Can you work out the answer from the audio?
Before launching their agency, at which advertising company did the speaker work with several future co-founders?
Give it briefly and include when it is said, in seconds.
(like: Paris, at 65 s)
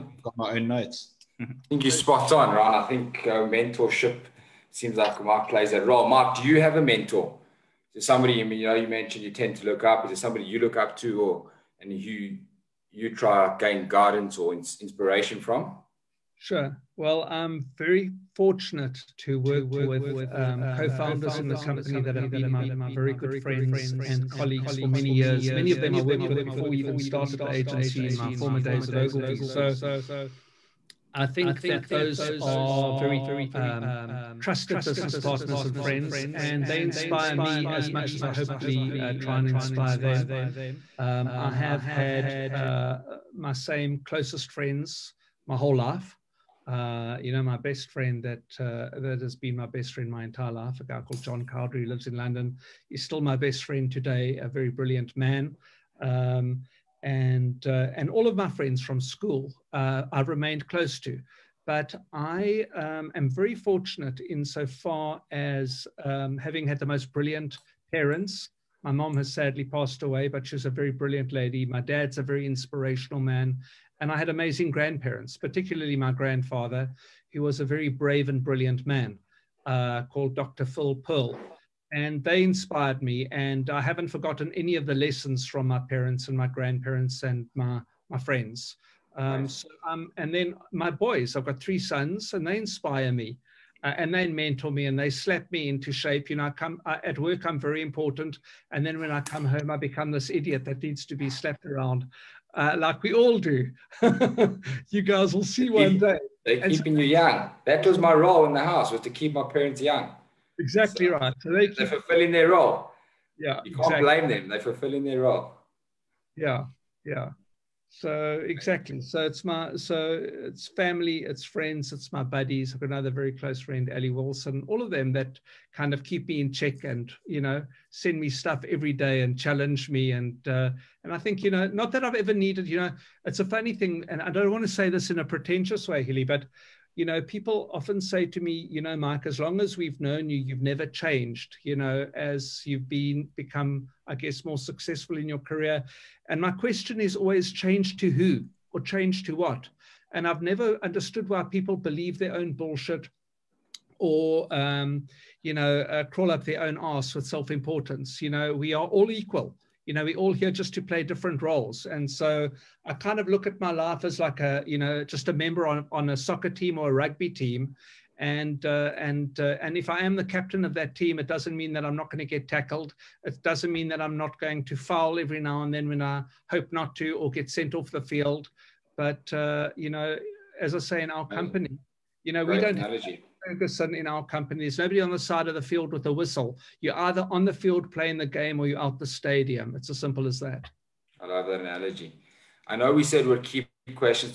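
Ogilvy, at 28 s.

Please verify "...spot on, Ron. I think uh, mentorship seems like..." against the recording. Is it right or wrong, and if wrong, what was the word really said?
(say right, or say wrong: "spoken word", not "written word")
right.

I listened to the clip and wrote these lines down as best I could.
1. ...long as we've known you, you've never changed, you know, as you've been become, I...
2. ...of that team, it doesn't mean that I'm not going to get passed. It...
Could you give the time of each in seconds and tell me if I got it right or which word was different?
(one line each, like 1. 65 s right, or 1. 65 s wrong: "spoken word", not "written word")
1. 139 s right
2. 170 s wrong: "tackled", not "passed".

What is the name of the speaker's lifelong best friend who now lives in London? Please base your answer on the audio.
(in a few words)
John Cowdery.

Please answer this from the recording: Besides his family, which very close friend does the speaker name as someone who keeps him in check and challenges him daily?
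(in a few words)
Ali Wilson.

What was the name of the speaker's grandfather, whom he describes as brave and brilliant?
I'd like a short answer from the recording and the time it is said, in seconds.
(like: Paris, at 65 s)
Dr. Phil Pearl, at 80 s.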